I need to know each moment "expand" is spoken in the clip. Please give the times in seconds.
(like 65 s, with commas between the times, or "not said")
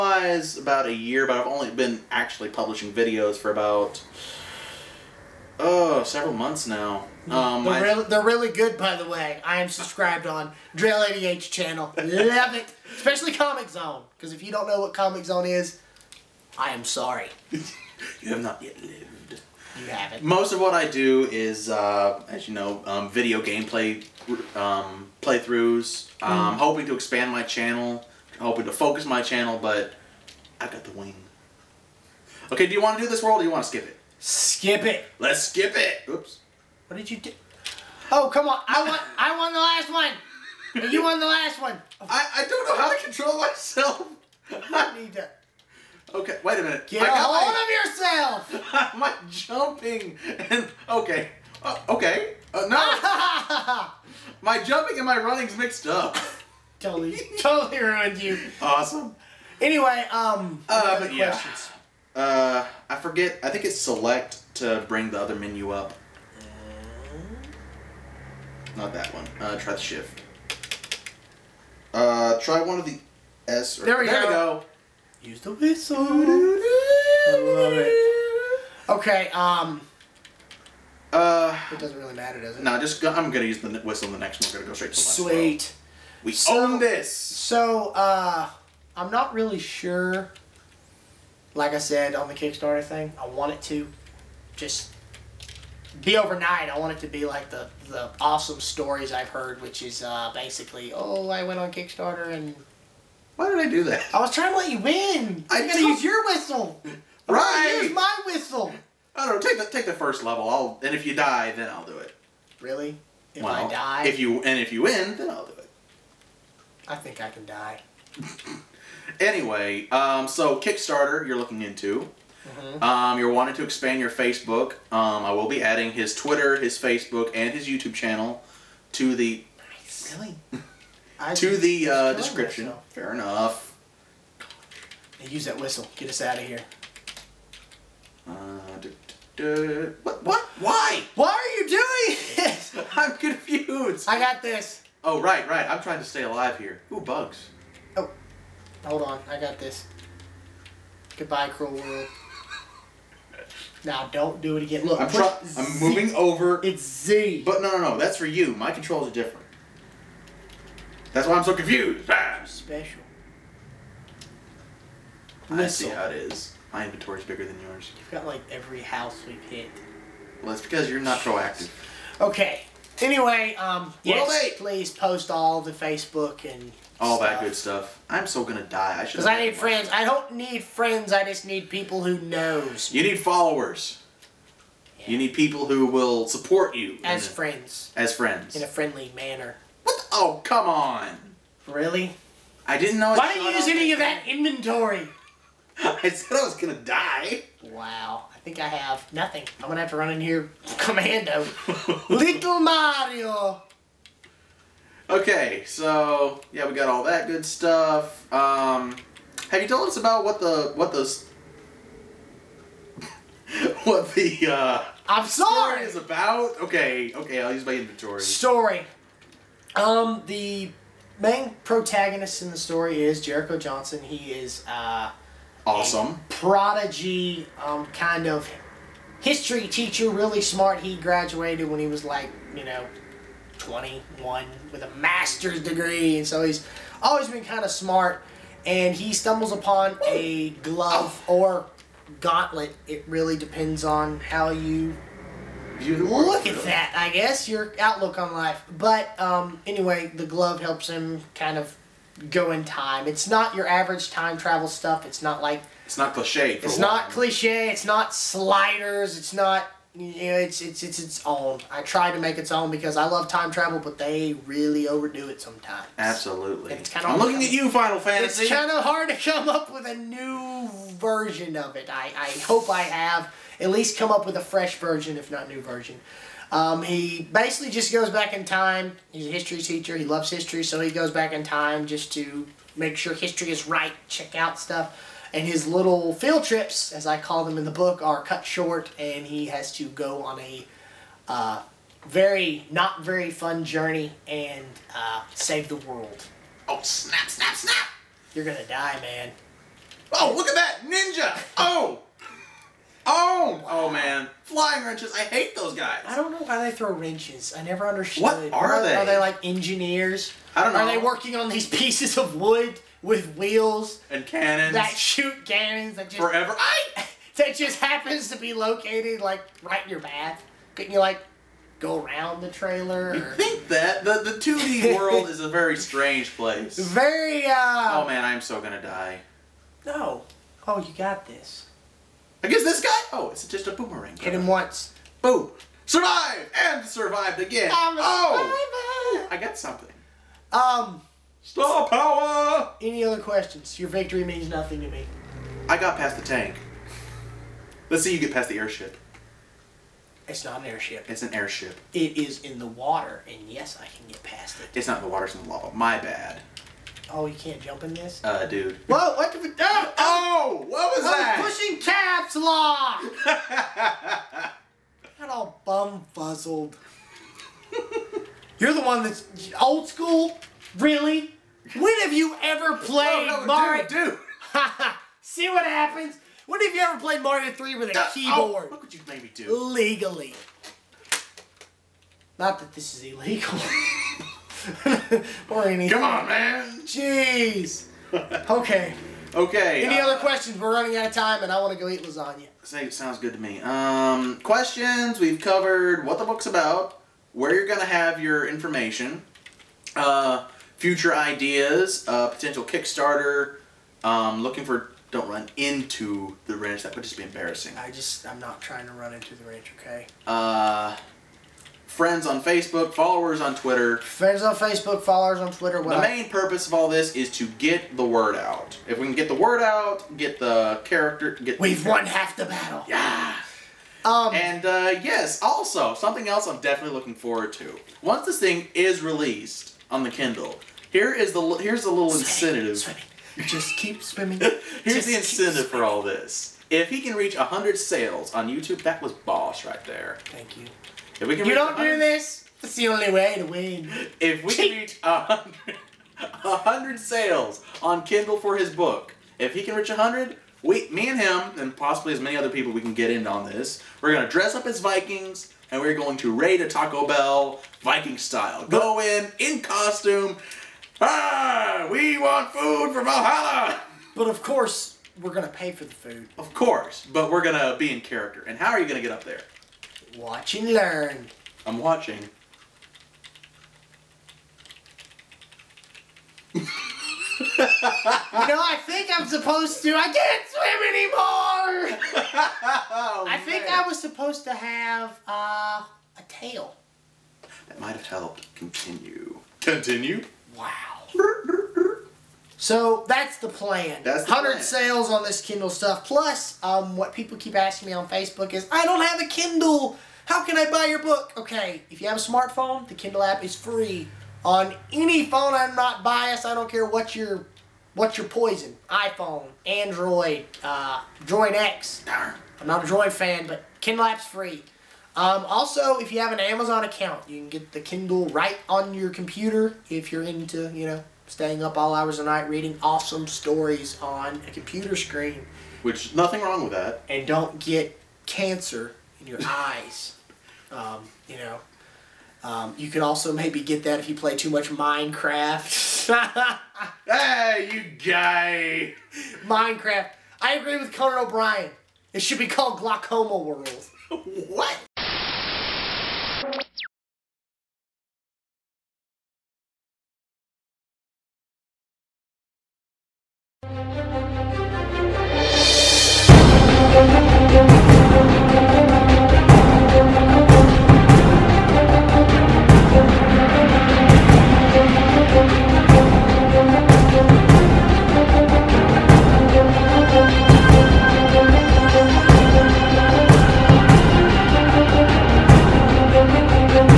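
26 s, 123 s.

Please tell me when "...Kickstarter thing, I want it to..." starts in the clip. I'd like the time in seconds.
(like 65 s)
92 s.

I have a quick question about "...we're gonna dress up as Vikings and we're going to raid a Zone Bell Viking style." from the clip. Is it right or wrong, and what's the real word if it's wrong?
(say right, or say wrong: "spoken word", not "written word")
wrong: "Taco", not "Zone".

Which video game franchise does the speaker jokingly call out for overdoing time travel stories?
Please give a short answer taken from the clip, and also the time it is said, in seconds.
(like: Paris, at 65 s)
Final Fantasy, at 267 s.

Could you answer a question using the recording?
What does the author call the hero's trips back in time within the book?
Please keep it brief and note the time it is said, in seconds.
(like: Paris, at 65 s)
Field trips, at 286 s.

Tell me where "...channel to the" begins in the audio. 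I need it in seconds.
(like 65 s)
127 s.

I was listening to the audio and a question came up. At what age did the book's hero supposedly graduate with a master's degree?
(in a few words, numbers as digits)
21.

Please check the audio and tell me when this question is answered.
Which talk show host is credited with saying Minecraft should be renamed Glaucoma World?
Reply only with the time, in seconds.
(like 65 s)
540 s.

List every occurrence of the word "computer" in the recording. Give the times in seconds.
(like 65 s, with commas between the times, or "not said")
519 s, 524 s.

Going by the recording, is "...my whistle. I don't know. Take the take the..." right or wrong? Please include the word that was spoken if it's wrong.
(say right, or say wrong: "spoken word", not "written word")
right.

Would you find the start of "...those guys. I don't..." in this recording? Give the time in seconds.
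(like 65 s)
305 s.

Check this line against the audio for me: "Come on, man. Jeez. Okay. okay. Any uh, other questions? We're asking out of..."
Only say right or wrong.
wrong.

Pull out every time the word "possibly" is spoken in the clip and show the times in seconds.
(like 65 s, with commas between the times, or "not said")
451 s.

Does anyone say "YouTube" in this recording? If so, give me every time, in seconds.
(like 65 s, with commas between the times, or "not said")
127 s, 438 s.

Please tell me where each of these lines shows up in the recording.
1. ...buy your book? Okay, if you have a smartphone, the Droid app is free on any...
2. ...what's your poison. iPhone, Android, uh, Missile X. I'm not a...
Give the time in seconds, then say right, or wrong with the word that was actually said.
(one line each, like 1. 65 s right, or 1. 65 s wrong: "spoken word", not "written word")
1. 500 s wrong: "Kindle", not "Droid"
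2. 507 s wrong: "Droid", not "Missile".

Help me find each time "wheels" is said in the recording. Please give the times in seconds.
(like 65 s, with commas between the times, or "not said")
313 s.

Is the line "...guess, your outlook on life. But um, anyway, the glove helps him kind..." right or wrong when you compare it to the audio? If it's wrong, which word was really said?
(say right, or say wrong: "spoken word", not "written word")
right.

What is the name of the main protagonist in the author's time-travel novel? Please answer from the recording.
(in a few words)
Jericho Johnson.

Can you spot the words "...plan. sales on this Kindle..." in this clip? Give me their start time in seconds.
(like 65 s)
494 s.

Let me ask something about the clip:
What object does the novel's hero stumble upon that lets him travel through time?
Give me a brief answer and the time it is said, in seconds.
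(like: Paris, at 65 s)
A glove or gauntlet, at 240 s.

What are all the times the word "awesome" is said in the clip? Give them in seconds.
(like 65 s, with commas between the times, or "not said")
58 s, 98 s, 225 s, 522 s.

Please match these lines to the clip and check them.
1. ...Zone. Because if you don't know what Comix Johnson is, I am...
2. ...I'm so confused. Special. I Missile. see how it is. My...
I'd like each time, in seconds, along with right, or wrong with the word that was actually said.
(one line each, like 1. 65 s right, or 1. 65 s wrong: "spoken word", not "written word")
1. 13 s wrong: "Zone", not "Johnson"
2. 161 s right.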